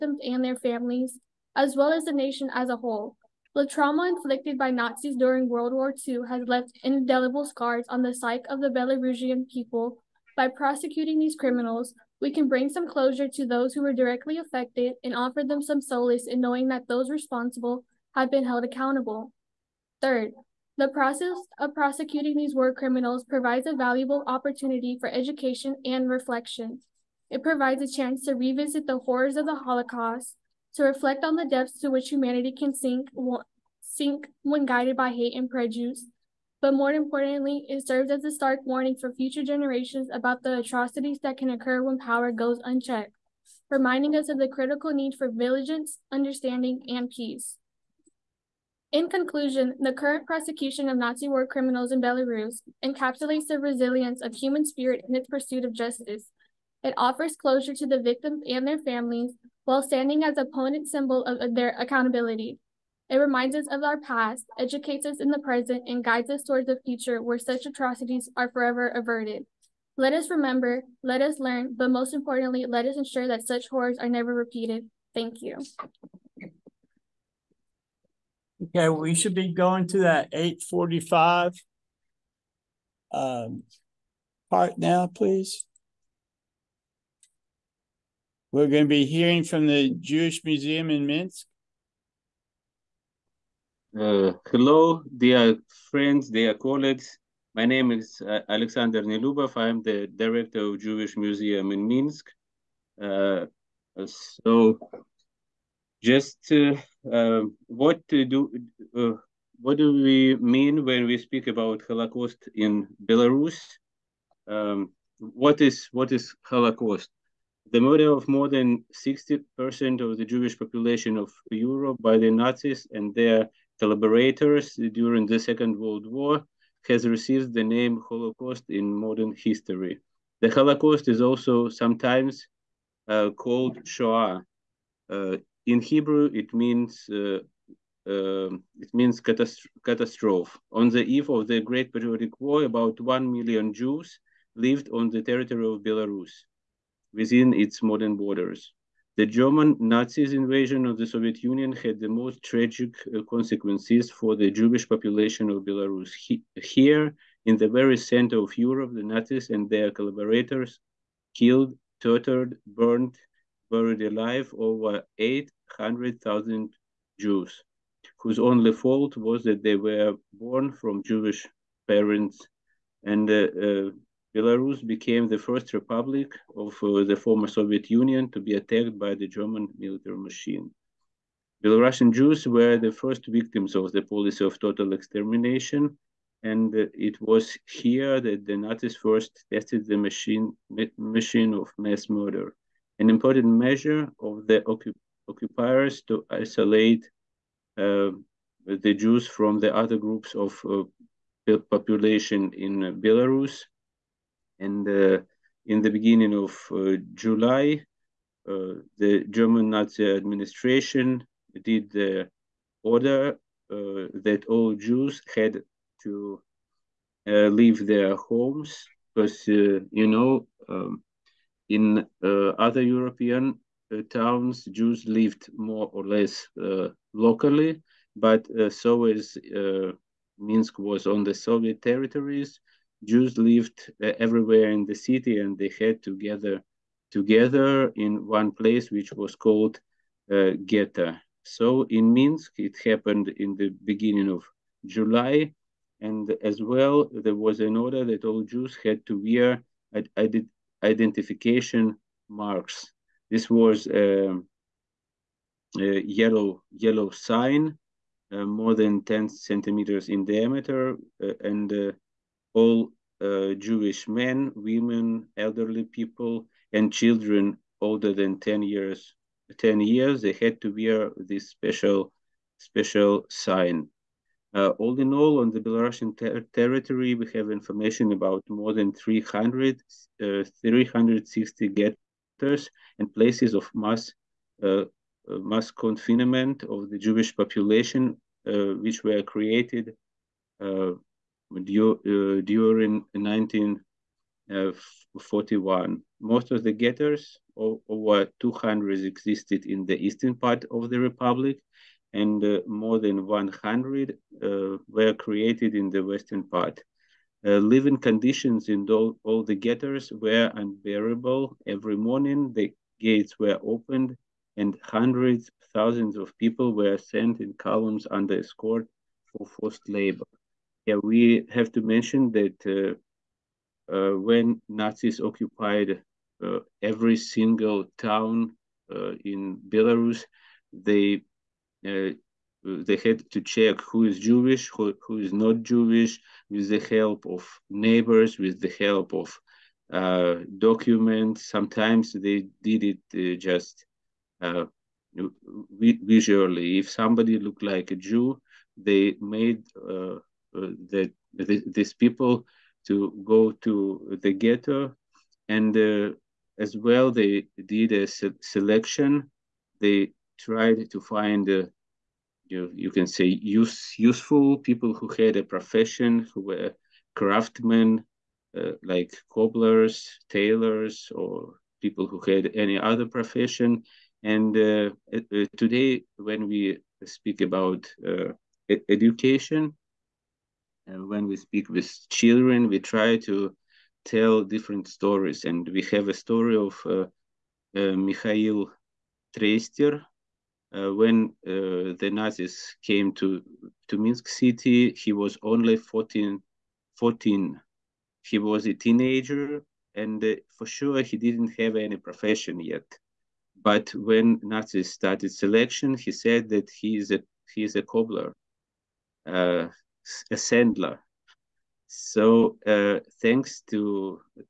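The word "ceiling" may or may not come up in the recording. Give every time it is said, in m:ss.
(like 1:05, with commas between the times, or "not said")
not said.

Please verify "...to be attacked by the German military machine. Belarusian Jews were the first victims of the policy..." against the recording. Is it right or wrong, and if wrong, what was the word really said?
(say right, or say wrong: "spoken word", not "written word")
right.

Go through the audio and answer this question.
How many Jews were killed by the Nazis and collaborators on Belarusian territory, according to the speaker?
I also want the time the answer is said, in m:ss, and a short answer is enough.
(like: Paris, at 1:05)
over 800,000, at 2:44.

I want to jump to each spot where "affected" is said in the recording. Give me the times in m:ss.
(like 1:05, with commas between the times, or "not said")
0:14.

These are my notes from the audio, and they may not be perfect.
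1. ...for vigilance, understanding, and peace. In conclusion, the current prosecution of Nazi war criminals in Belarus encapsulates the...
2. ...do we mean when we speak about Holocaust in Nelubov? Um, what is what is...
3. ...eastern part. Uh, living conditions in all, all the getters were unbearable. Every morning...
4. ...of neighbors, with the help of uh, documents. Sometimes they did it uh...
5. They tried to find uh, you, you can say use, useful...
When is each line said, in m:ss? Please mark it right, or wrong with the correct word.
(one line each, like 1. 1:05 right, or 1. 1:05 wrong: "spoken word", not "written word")
1. 0:45 right
2. 1:49 wrong: "Belarus", not "Nelubov"
3. 5:06 wrong: "western", not "eastern"
4. 5:37 right
5. 5:59 right.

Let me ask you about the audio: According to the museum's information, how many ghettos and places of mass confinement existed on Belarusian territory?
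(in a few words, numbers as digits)
360.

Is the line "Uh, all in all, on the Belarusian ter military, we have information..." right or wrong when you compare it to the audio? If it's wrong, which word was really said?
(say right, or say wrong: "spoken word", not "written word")
wrong: "territory", not "military".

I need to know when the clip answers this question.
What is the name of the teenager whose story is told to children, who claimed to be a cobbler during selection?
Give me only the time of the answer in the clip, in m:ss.
6:27.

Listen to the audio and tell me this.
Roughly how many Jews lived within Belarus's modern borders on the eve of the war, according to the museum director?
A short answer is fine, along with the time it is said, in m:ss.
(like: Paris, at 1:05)
about one million, at 2:22.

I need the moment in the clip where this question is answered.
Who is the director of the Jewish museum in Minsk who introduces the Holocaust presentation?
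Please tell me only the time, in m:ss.
1:38.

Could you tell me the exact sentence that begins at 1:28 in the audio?
We're going to be hearing from the Jewish Museum in Minsk.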